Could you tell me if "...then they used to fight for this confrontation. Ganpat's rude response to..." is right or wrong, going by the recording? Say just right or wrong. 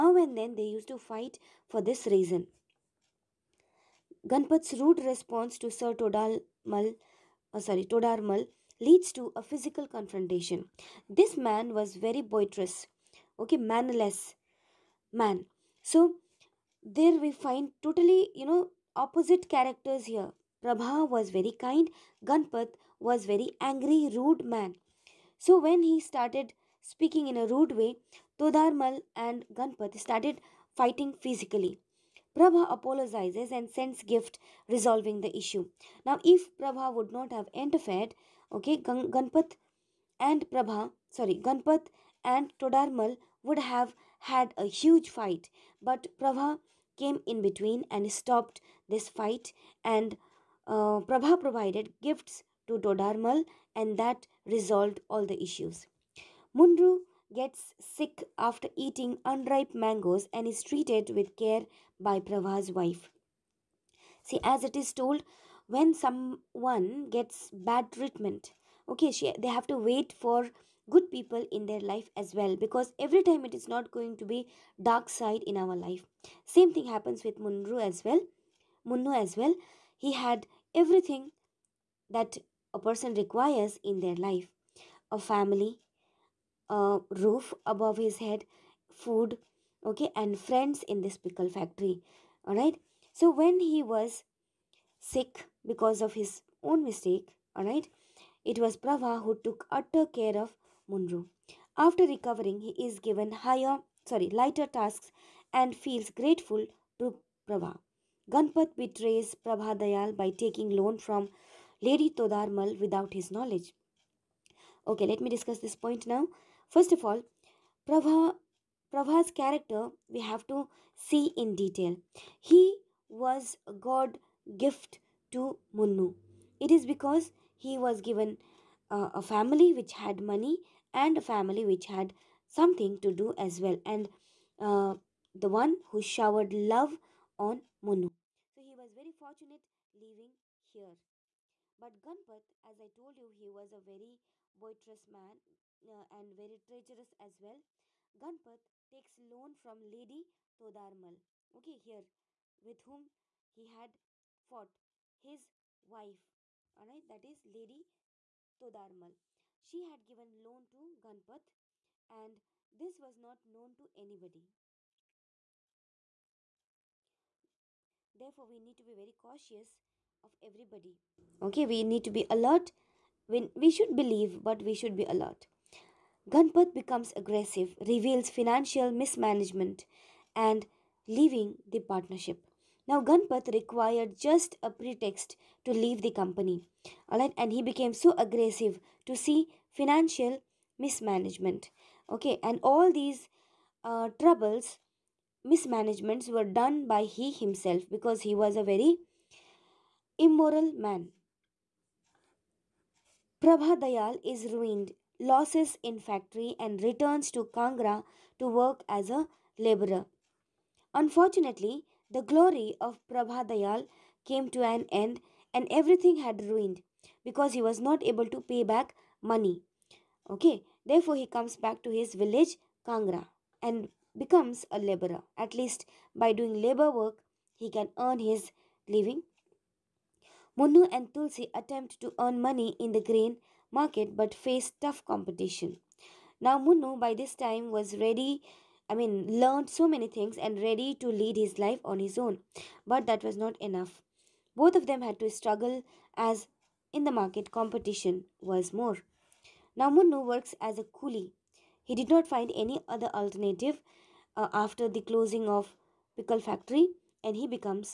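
wrong.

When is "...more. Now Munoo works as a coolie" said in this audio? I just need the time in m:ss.
4:08.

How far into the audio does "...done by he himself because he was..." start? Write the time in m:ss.
3:16.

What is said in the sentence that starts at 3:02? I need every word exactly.
Now, Ganpat required just a pretext to leave the company.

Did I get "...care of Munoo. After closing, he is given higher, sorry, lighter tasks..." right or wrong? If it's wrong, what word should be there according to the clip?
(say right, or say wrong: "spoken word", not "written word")
wrong: "recovering", not "closing".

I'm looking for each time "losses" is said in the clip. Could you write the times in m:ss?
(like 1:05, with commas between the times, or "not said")
3:25.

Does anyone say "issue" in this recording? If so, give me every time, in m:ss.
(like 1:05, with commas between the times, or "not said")
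0:35, 0:55.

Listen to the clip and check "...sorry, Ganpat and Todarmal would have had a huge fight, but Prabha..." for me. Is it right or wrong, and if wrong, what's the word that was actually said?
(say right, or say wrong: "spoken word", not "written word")
right.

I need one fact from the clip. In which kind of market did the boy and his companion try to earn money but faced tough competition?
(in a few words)
Grain market.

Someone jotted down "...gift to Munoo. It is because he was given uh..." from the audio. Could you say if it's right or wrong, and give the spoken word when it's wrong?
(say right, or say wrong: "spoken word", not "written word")
right.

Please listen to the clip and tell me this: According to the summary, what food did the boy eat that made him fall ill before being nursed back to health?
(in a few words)
Unripe mangoes.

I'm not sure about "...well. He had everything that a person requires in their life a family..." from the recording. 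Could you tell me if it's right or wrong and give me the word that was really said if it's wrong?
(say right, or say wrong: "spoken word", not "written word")
right.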